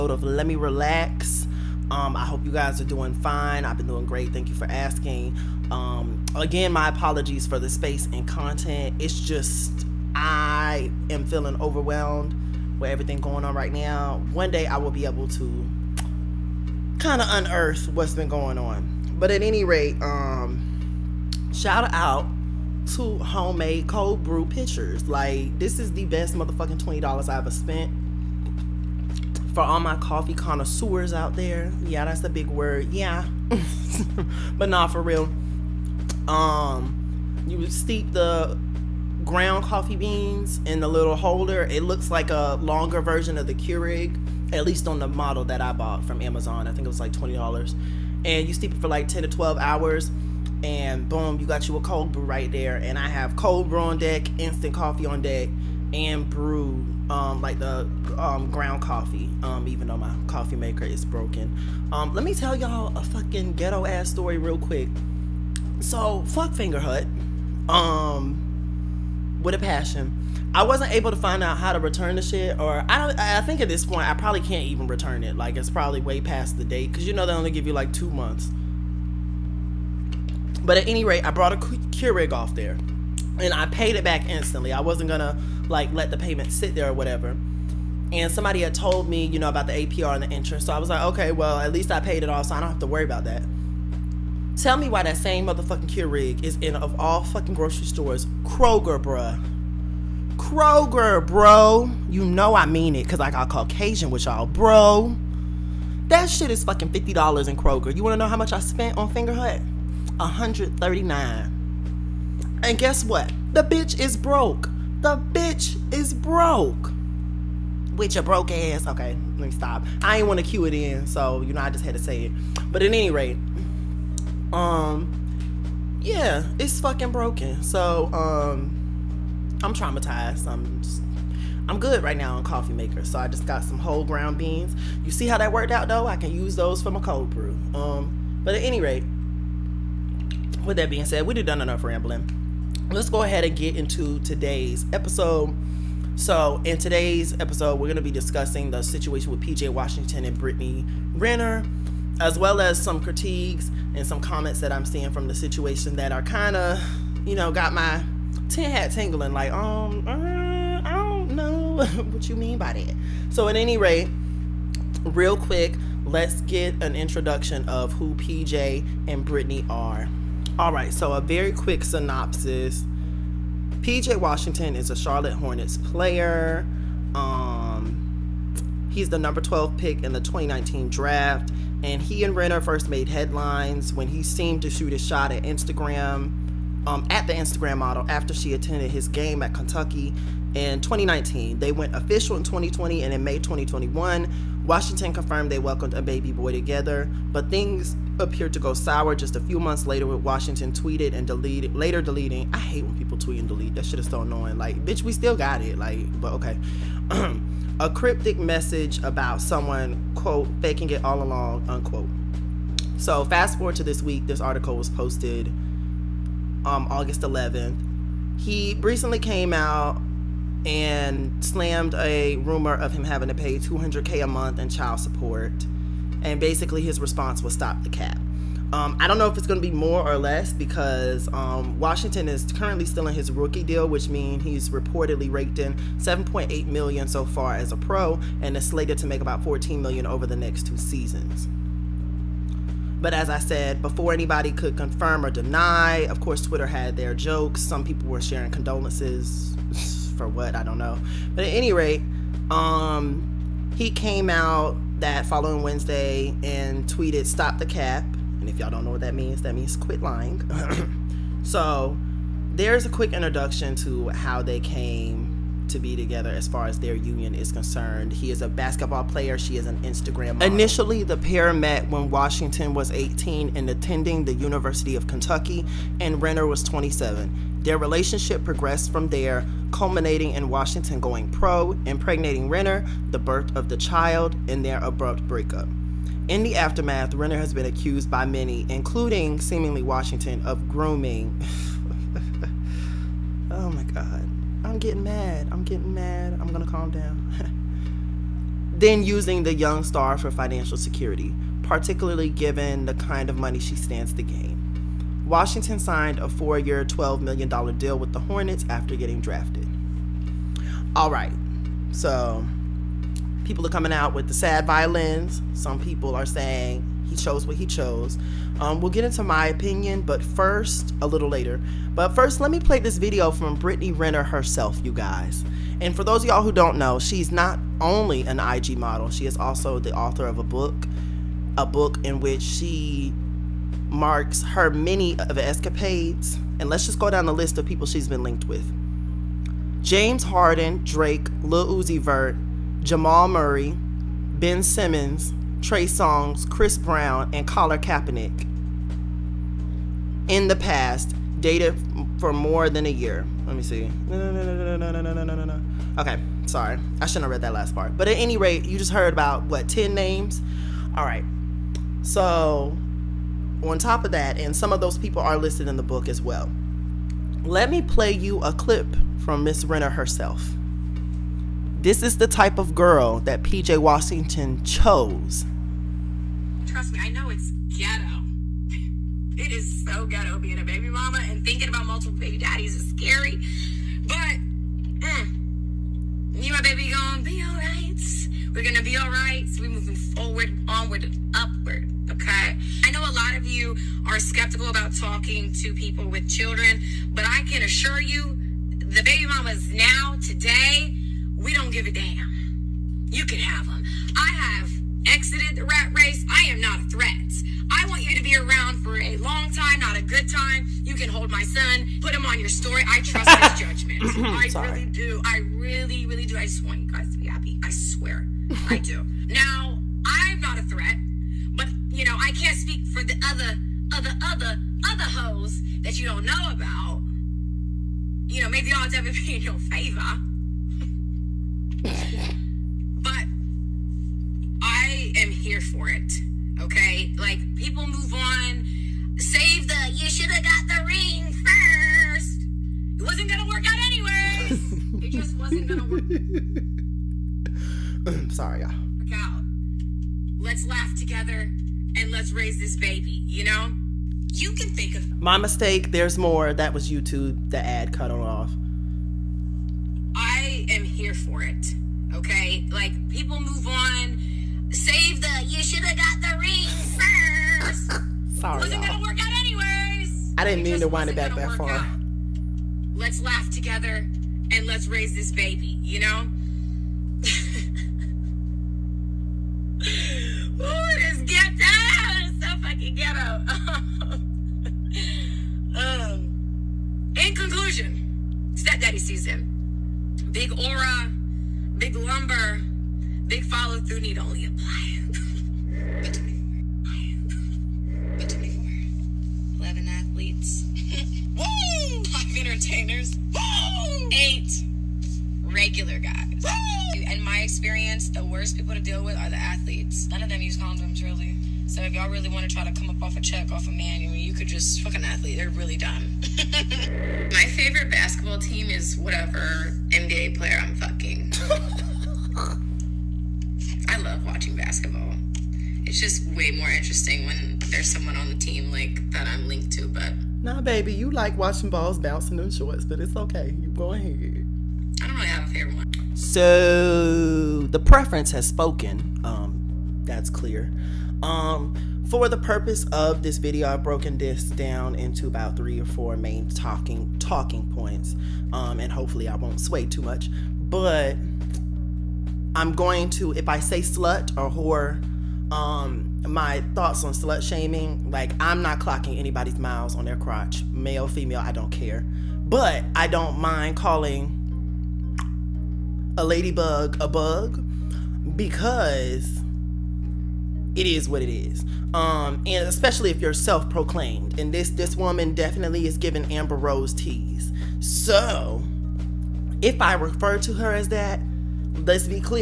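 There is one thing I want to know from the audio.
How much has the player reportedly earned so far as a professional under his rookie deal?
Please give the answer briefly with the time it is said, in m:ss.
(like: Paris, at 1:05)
7.8 million, at 3:55.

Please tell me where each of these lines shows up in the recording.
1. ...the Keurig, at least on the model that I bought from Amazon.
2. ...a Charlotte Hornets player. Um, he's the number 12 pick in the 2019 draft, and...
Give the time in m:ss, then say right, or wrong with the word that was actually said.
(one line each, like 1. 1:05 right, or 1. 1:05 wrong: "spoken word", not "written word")
1. 0:43 right
2. 2:54 right.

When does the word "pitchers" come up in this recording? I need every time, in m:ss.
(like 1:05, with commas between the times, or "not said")
0:24.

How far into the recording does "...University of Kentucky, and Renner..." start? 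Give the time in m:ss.
4:34.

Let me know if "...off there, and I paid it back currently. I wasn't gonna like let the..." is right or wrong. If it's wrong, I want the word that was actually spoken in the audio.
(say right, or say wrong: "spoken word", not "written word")
wrong: "instantly", not "currently".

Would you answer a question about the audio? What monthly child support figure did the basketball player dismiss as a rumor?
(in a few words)
200K.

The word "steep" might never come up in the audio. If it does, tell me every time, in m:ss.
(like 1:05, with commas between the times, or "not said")
0:37, 0:48.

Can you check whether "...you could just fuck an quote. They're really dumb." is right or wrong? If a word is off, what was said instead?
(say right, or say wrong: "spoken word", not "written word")
wrong: "athlete", not "quote".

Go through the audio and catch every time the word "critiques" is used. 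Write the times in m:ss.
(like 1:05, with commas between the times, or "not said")
2:32.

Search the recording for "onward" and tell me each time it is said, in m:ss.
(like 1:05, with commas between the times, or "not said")
6:30.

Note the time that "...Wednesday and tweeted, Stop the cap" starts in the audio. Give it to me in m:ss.
4:15.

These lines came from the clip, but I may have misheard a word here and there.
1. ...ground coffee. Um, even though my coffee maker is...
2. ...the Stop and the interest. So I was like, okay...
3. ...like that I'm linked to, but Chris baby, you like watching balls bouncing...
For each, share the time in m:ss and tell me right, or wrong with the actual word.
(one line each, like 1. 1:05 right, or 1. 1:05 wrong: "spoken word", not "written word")
1. 0:58 right
2. 1:29 wrong: "APR", not "Stop"
3. 8:48 wrong: "Nah", not "Chris".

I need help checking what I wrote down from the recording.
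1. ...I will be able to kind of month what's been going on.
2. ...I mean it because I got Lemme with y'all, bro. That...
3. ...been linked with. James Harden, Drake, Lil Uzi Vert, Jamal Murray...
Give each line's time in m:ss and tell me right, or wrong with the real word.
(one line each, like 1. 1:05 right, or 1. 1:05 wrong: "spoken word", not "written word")
1. 0:14 wrong: "unearth", not "month"
2. 1:42 wrong: "Caucasian", not "Lemme"
3. 5:38 right.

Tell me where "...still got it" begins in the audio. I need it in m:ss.
3:25.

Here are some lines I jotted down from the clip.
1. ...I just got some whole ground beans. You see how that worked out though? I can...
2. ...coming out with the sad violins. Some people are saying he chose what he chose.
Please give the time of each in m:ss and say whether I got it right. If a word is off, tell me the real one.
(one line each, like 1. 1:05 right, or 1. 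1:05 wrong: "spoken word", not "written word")
1. 2:13 right
2. 5:13 right.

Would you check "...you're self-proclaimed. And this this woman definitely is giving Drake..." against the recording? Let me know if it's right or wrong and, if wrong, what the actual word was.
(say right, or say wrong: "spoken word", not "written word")
wrong: "Amber", not "Drake".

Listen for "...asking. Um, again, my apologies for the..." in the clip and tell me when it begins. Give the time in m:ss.
0:04.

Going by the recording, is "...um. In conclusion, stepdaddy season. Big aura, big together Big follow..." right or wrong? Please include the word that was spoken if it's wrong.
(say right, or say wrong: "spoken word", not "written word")
wrong: "lumber", not "together".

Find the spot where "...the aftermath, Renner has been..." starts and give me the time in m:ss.
4:46.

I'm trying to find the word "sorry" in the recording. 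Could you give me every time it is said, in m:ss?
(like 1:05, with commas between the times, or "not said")
5:56, 6:54, 7:28, 7:48.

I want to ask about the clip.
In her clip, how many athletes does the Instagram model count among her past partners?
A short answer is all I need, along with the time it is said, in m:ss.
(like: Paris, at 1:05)
11, at 8:19.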